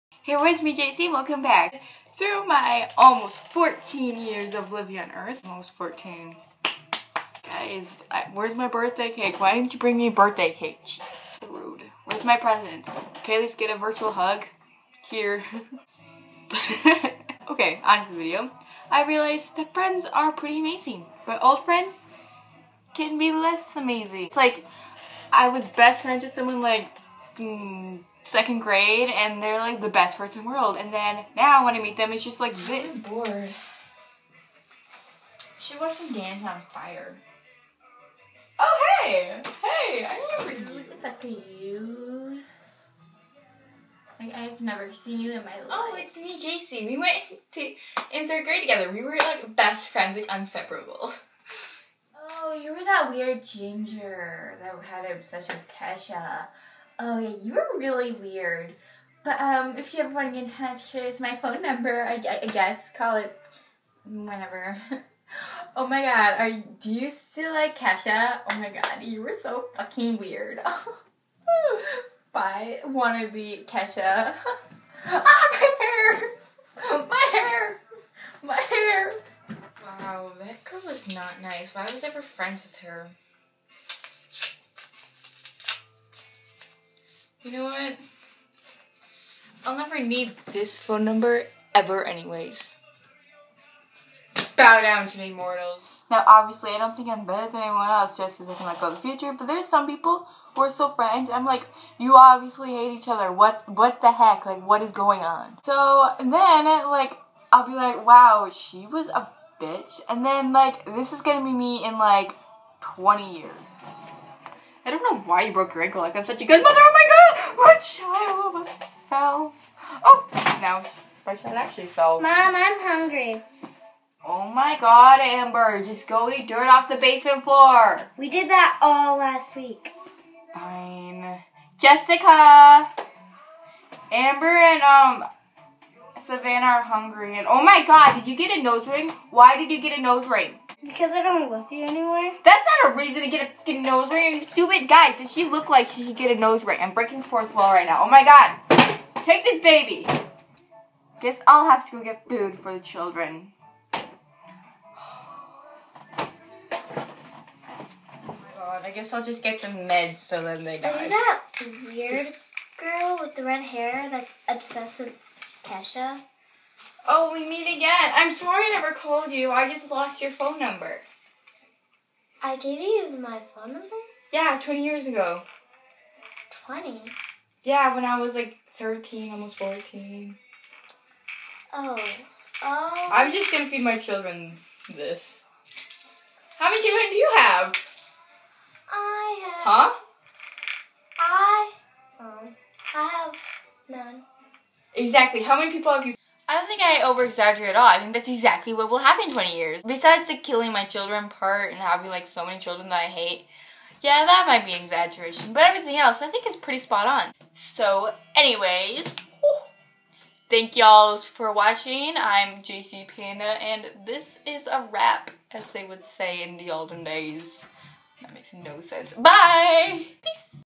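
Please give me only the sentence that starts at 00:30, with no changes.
And then now when I meet them, it's just like this.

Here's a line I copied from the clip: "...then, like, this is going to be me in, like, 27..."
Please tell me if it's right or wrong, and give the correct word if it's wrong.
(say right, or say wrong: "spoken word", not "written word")
wrong: "20", not "27".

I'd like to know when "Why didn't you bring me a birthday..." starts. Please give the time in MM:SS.
00:09.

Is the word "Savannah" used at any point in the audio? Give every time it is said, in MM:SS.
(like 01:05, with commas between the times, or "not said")
02:16.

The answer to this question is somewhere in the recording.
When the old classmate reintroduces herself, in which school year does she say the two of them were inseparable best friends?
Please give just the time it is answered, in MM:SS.
00:48.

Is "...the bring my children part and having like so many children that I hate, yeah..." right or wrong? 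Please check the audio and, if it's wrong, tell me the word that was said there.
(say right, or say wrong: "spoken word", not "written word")
wrong: "killing", not "bring".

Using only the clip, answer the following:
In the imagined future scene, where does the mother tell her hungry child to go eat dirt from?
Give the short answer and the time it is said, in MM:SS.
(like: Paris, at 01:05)
the basement floor, at 02:06.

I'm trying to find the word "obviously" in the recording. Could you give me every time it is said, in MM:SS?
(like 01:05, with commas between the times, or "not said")
01:36, 01:42.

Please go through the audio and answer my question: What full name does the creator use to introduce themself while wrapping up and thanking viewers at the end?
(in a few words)
JC Panda.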